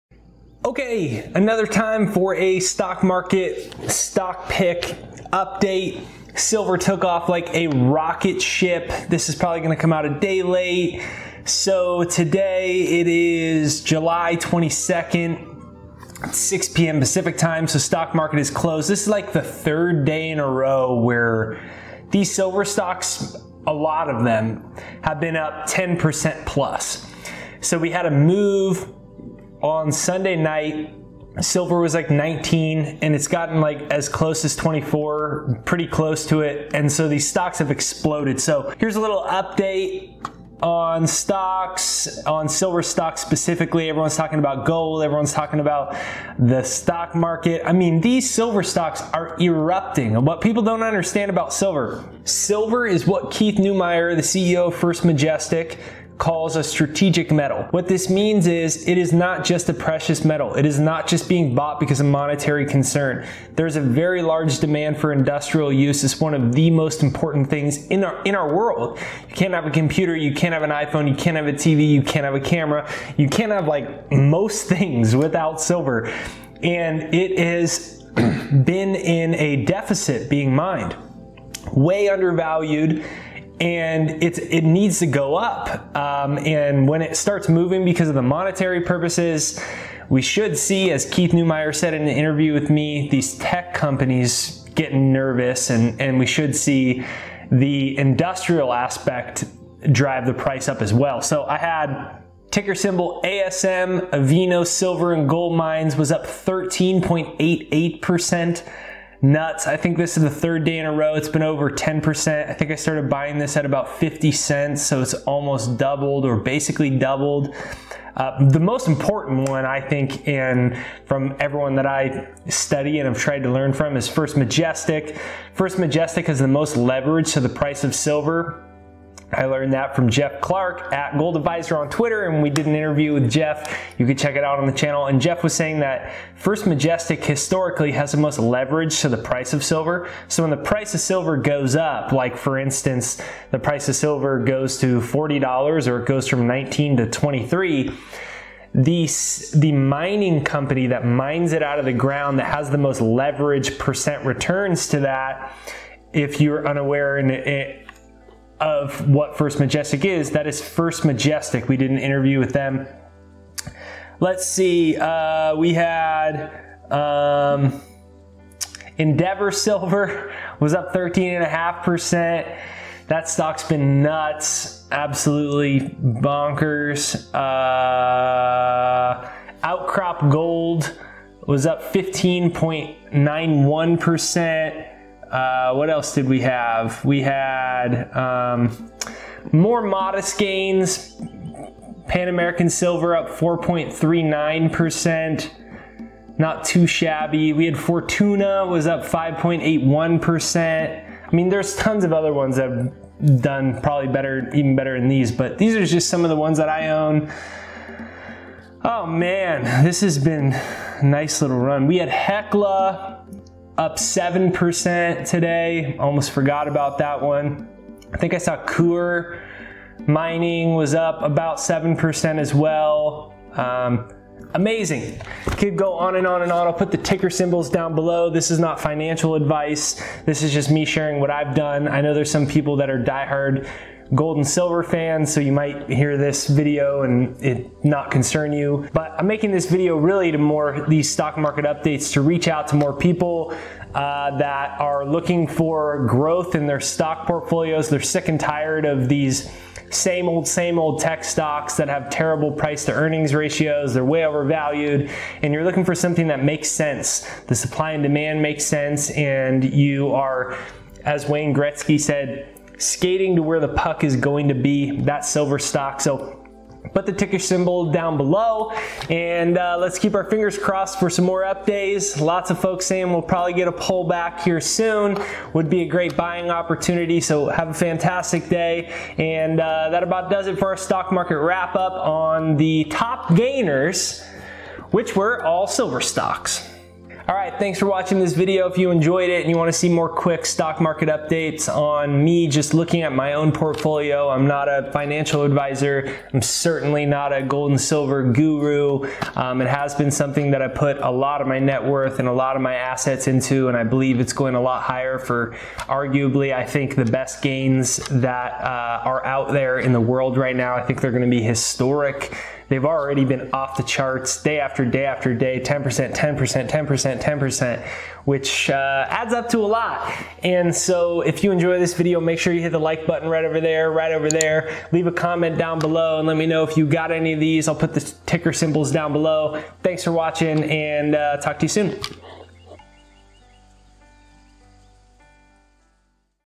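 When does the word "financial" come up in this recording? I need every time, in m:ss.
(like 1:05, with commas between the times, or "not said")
3:48, 4:54.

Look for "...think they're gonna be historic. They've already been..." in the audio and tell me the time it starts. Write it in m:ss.
5:10.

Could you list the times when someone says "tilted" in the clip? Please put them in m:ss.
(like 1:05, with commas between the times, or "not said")
not said.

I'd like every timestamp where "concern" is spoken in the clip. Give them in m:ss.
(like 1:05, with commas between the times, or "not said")
1:02, 3:58.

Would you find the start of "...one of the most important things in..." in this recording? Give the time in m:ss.
1:06.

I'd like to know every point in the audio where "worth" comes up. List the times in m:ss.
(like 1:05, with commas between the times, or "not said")
5:01.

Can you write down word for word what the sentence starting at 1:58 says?
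Uh, the most important one, I think, and from everyone that I study and have tried to learn from is First Majestic.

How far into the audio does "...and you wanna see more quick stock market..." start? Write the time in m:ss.
4:49.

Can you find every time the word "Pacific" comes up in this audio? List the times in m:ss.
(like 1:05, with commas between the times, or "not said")
0:16.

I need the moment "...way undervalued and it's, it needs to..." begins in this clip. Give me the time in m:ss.
1:21.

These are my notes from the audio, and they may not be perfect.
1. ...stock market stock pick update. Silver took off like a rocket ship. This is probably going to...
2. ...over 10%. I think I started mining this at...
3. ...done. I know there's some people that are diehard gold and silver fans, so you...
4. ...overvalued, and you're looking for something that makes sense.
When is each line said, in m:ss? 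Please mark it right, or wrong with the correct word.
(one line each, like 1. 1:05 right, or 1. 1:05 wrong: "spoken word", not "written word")
1. 0:02 right
2. 1:51 wrong: "buying", not "mining"
3. 3:51 right
4. 4:14 right.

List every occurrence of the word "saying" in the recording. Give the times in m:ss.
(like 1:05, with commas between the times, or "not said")
2:15, 4:32.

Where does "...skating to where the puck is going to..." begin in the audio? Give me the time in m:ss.
4:22.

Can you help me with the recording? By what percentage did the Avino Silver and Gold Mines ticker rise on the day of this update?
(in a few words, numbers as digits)
13.88%.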